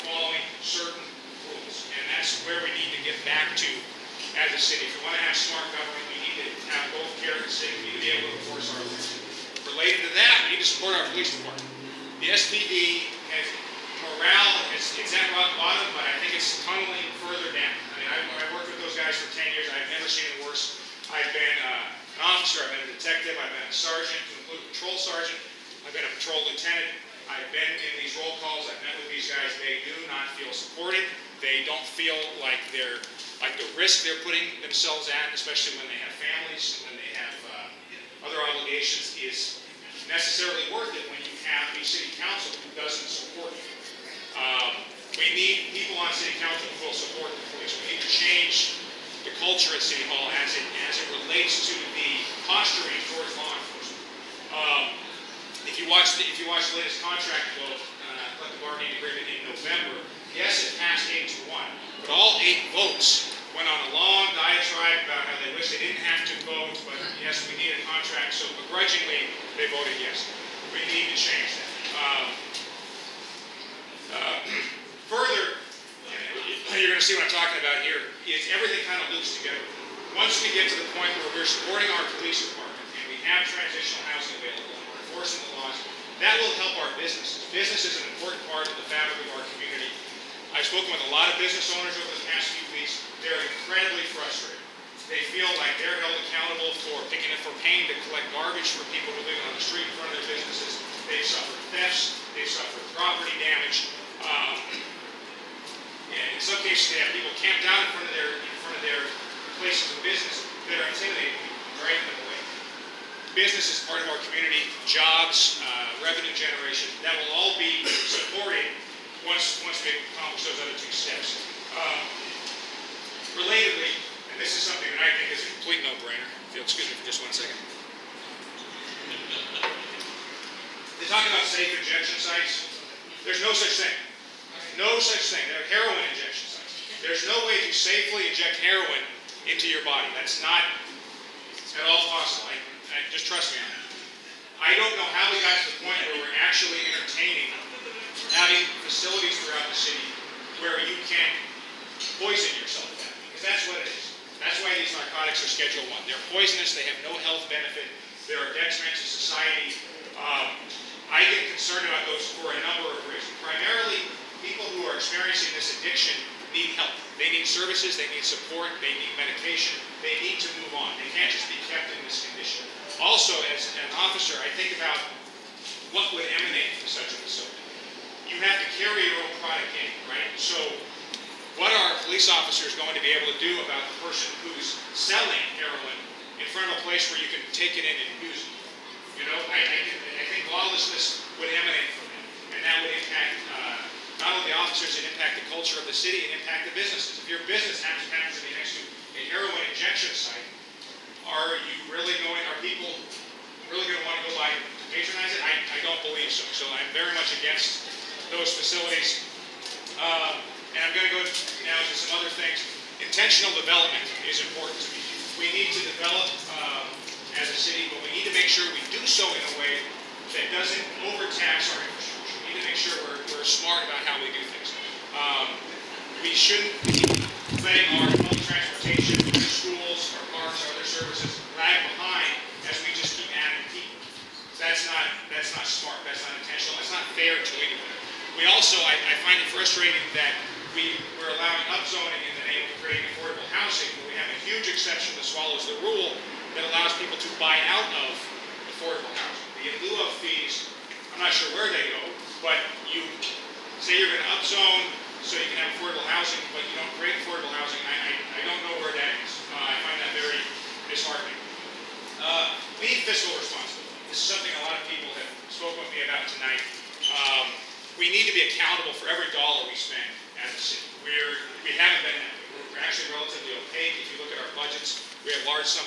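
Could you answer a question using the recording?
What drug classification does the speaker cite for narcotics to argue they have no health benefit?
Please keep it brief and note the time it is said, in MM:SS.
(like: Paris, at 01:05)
Schedule 1, at 02:35.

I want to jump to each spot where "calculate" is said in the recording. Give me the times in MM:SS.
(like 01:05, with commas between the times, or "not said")
not said.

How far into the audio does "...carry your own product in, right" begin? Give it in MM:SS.
02:58.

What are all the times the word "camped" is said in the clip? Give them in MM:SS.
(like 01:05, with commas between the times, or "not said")
01:47.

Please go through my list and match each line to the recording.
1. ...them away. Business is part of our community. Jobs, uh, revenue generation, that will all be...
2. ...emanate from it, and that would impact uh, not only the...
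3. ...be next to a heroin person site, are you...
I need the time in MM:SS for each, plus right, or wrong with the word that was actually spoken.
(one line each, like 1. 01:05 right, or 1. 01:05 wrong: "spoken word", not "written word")
1. 01:52 right
2. 03:11 right
3. 03:18 wrong: "injection", not "person".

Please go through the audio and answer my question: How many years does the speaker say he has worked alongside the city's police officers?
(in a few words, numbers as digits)
10 years.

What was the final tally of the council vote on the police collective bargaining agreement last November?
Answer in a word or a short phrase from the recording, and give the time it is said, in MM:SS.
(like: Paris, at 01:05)
8 to 1, at 01:01.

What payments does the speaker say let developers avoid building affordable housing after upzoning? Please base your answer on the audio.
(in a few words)
in lieu of fees.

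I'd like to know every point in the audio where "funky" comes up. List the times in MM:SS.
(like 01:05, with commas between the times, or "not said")
not said.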